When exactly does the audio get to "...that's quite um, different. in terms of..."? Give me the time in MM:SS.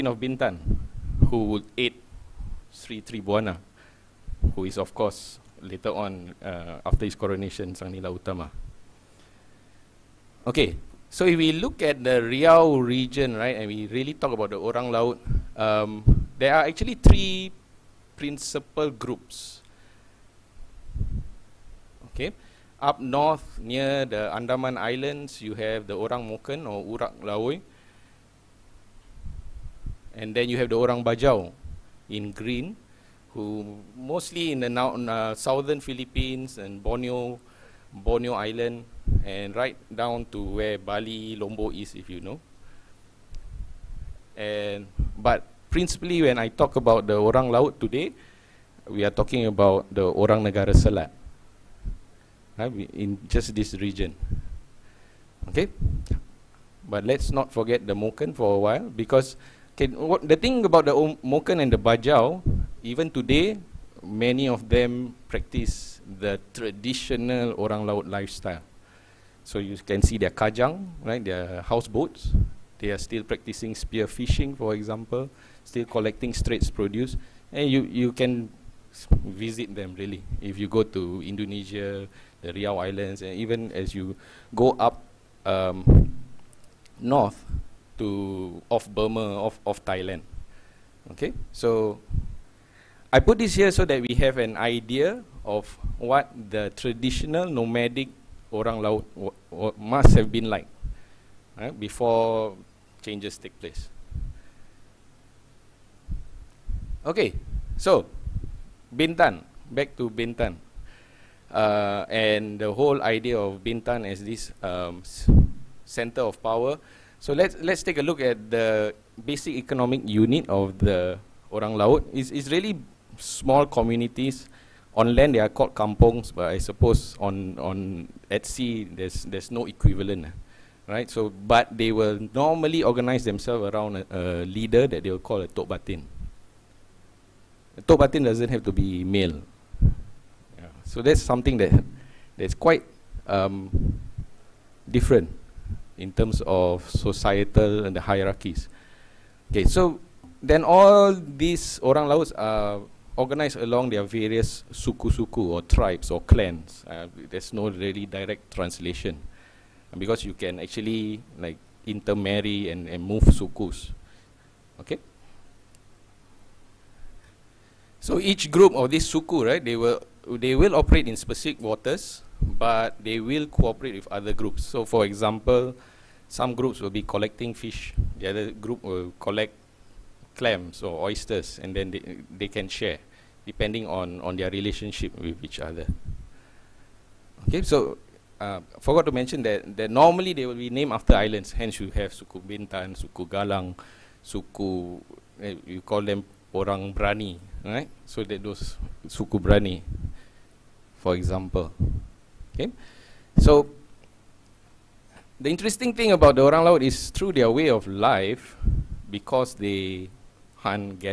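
02:22.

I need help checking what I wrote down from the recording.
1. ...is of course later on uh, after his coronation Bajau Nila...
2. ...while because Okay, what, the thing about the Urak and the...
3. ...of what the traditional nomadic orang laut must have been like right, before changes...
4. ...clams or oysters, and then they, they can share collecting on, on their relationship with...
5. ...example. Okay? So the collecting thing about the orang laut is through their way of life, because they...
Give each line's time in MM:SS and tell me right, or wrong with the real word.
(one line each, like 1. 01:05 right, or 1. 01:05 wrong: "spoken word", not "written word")
1. 00:04 wrong: "Sang", not "Bajau"
2. 00:58 wrong: "Moken", not "Urak"
3. 01:35 right
4. 03:00 wrong: "depending", not "collecting"
5. 03:21 wrong: "interesting", not "collecting".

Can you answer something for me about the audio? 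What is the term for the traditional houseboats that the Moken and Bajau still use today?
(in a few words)
kajang.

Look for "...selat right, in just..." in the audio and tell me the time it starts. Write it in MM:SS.
00:50.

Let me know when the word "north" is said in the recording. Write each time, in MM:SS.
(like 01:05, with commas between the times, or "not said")
00:23, 01:26.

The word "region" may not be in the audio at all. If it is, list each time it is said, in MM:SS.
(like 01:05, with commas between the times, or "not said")
00:12, 00:53.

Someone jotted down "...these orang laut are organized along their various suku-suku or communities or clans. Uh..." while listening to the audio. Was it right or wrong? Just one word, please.
wrong.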